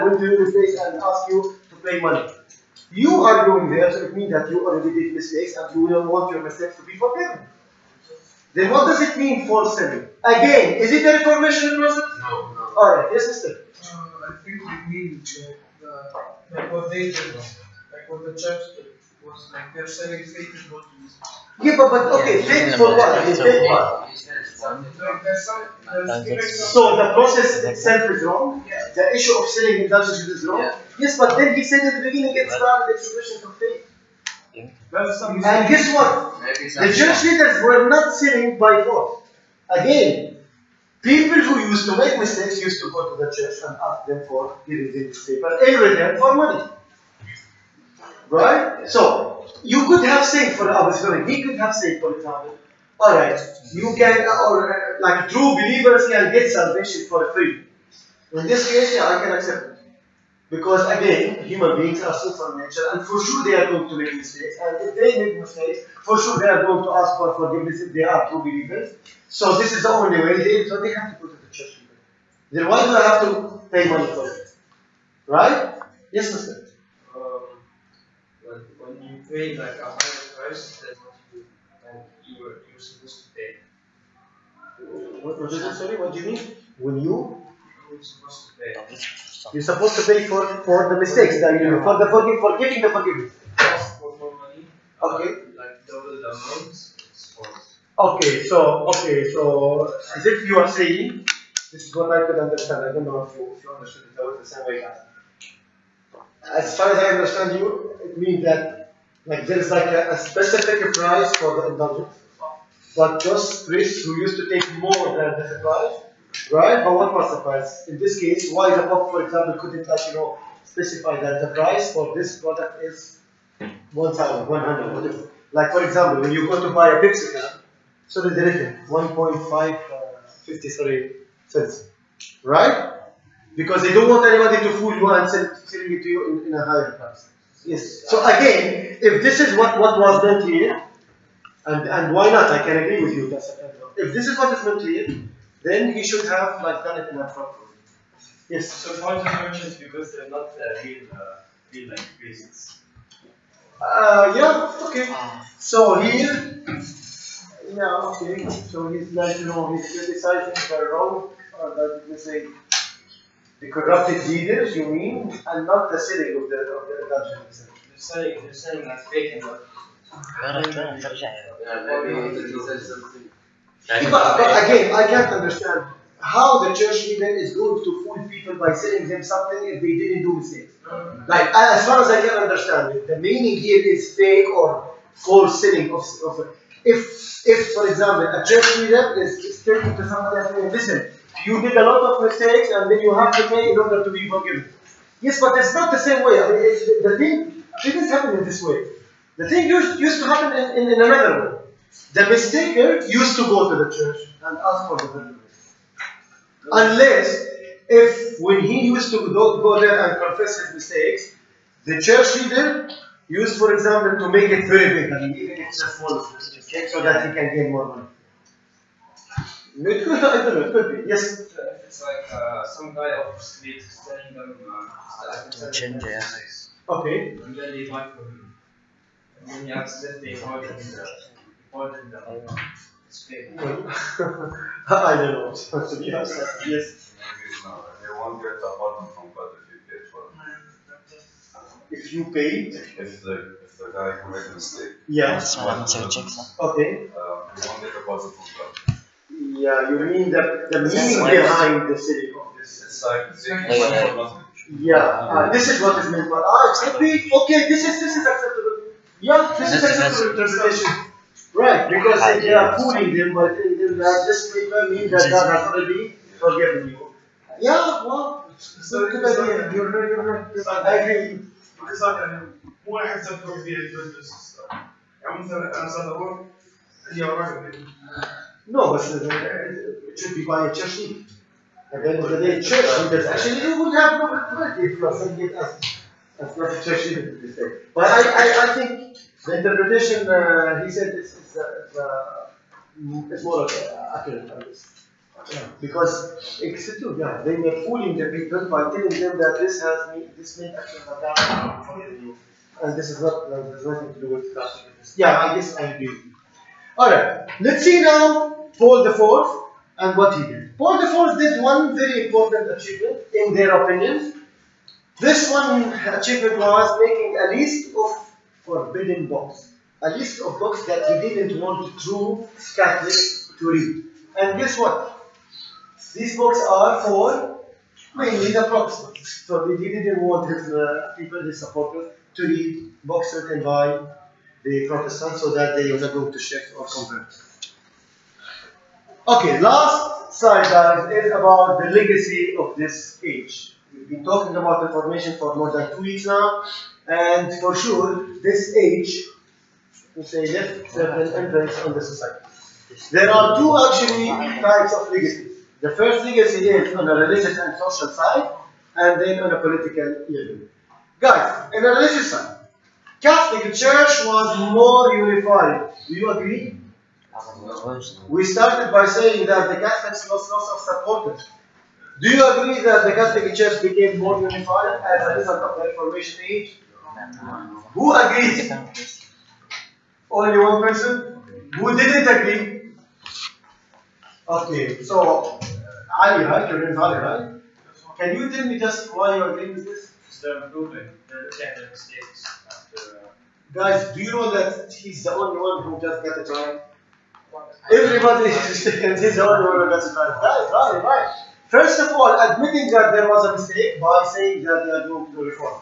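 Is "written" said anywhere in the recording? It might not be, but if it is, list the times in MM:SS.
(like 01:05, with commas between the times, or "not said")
02:08, 05:33.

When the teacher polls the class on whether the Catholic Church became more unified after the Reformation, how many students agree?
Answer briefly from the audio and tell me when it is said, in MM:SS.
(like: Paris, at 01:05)
1, at 06:20.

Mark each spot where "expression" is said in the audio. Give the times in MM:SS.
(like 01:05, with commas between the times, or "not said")
00:32.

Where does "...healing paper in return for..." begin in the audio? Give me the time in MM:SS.
00:44.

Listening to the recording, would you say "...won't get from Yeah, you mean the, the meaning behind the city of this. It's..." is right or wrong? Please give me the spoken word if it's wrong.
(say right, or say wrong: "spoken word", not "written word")
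right.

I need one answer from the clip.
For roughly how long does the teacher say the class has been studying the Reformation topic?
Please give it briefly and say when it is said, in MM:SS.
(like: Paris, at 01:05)
More than two weeks, at 05:45.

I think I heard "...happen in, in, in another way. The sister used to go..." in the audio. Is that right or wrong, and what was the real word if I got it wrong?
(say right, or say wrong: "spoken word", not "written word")
wrong: "mistaker", not "sister".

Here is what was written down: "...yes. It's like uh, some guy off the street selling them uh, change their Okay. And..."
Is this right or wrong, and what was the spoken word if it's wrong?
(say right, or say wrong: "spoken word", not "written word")
right.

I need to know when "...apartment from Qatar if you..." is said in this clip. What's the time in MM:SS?
03:58.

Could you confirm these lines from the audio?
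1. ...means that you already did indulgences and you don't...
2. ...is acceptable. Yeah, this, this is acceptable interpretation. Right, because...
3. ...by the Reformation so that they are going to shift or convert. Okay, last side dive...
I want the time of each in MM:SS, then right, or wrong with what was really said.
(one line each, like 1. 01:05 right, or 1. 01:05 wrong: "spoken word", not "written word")
1. 00:04 wrong: "mistakes", not "indulgences"
2. 04:18 right
3. 05:33 wrong: "Protestants", not "Reformation".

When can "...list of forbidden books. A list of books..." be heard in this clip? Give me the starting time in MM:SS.
05:17.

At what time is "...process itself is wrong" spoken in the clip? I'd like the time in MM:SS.
00:27.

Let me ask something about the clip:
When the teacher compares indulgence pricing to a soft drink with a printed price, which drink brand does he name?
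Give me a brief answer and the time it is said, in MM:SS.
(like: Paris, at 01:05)
Pepsi, at 02:07.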